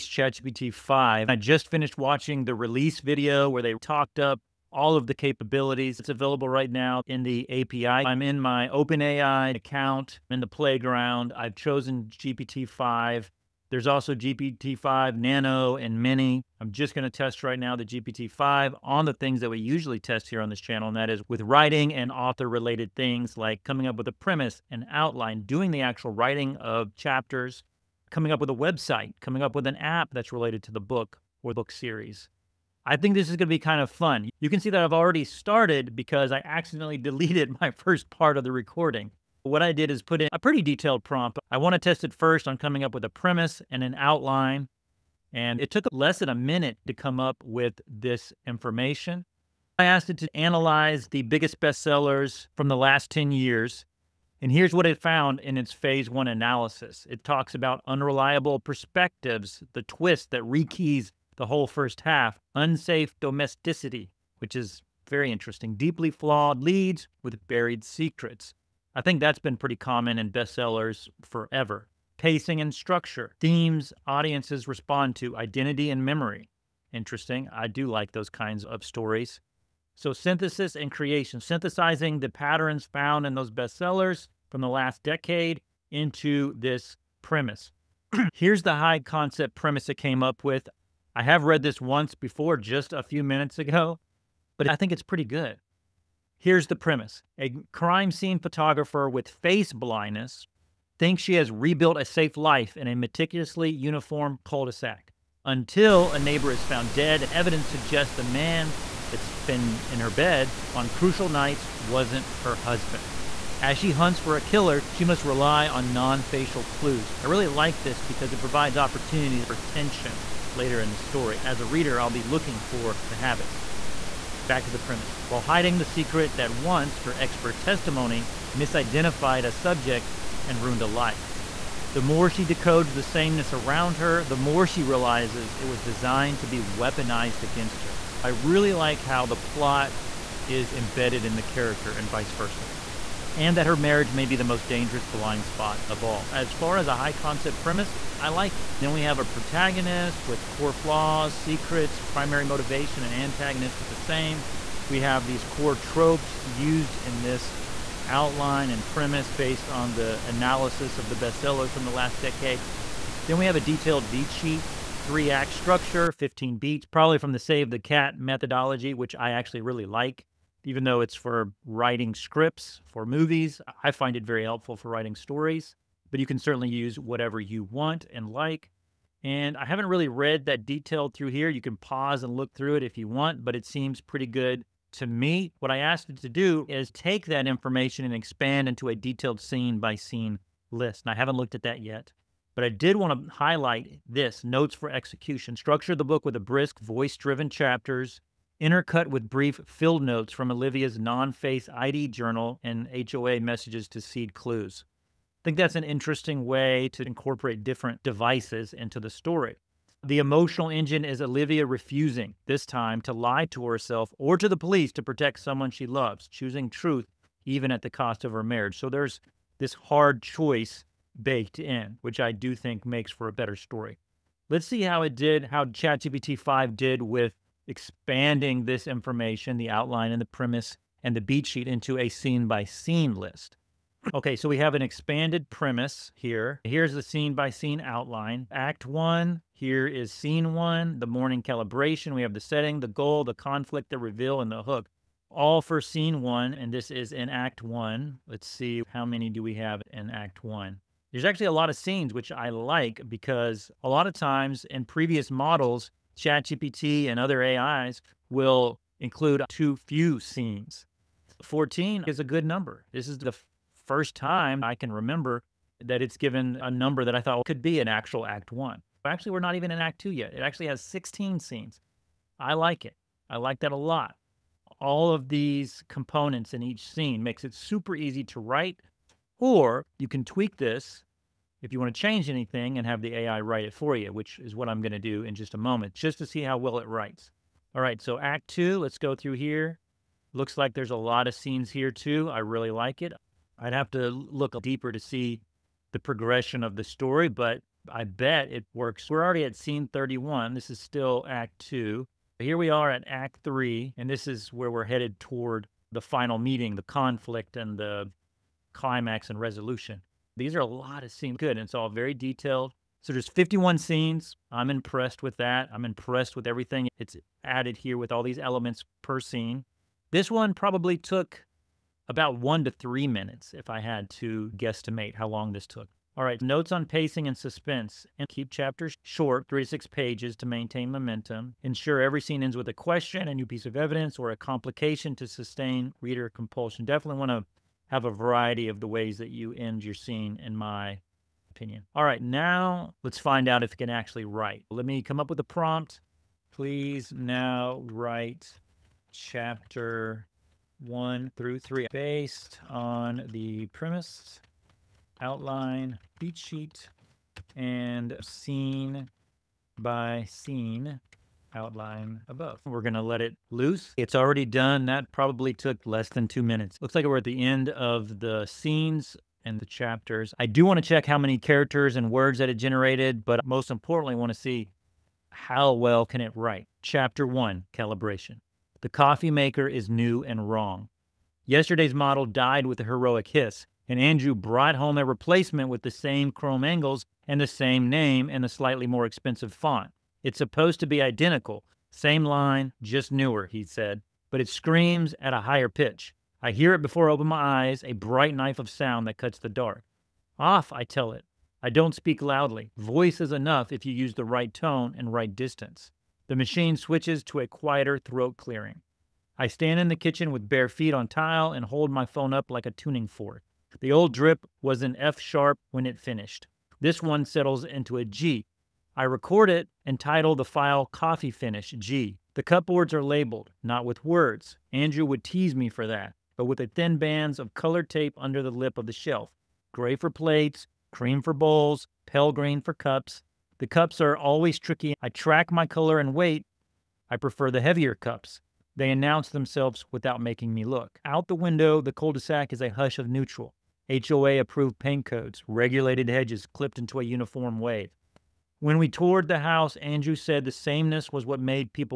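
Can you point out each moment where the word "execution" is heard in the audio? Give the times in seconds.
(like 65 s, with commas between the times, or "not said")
194 s.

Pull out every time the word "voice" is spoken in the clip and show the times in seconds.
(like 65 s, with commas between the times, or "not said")
196 s, 402 s.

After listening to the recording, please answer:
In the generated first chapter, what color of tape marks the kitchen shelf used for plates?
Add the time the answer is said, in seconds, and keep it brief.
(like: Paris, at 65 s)
Gray, at 429 s.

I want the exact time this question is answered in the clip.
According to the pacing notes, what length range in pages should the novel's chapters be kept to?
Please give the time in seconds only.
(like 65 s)
329 s.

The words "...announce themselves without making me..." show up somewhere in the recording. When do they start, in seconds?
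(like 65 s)
438 s.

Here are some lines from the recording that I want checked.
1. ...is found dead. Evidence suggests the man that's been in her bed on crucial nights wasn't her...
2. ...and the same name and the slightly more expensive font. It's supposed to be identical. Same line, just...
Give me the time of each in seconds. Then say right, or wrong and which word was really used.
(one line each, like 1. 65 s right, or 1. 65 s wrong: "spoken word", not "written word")
1. 106 s right
2. 387 s right.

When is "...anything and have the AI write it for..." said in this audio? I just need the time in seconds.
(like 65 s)
282 s.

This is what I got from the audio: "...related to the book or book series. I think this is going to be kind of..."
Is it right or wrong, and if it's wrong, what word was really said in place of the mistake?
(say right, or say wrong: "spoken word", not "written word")
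right.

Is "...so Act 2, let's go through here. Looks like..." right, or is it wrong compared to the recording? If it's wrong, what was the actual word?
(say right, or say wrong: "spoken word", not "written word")
right.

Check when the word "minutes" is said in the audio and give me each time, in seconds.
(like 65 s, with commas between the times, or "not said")
46 s, 93 s, 323 s, 366 s.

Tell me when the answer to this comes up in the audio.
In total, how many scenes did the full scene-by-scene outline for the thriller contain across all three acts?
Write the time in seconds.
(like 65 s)
313 s.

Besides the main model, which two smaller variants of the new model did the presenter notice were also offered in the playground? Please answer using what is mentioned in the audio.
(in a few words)
Nano and Mini.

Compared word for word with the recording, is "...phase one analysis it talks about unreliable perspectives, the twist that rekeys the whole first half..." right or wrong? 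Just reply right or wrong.
right.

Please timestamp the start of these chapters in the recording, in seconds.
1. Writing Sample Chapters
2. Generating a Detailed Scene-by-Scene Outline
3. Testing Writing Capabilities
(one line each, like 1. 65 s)
1. 341 s
2. 224 s
3. 16 s.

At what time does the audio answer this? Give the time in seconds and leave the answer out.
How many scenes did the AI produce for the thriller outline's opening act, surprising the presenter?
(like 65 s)
270 s.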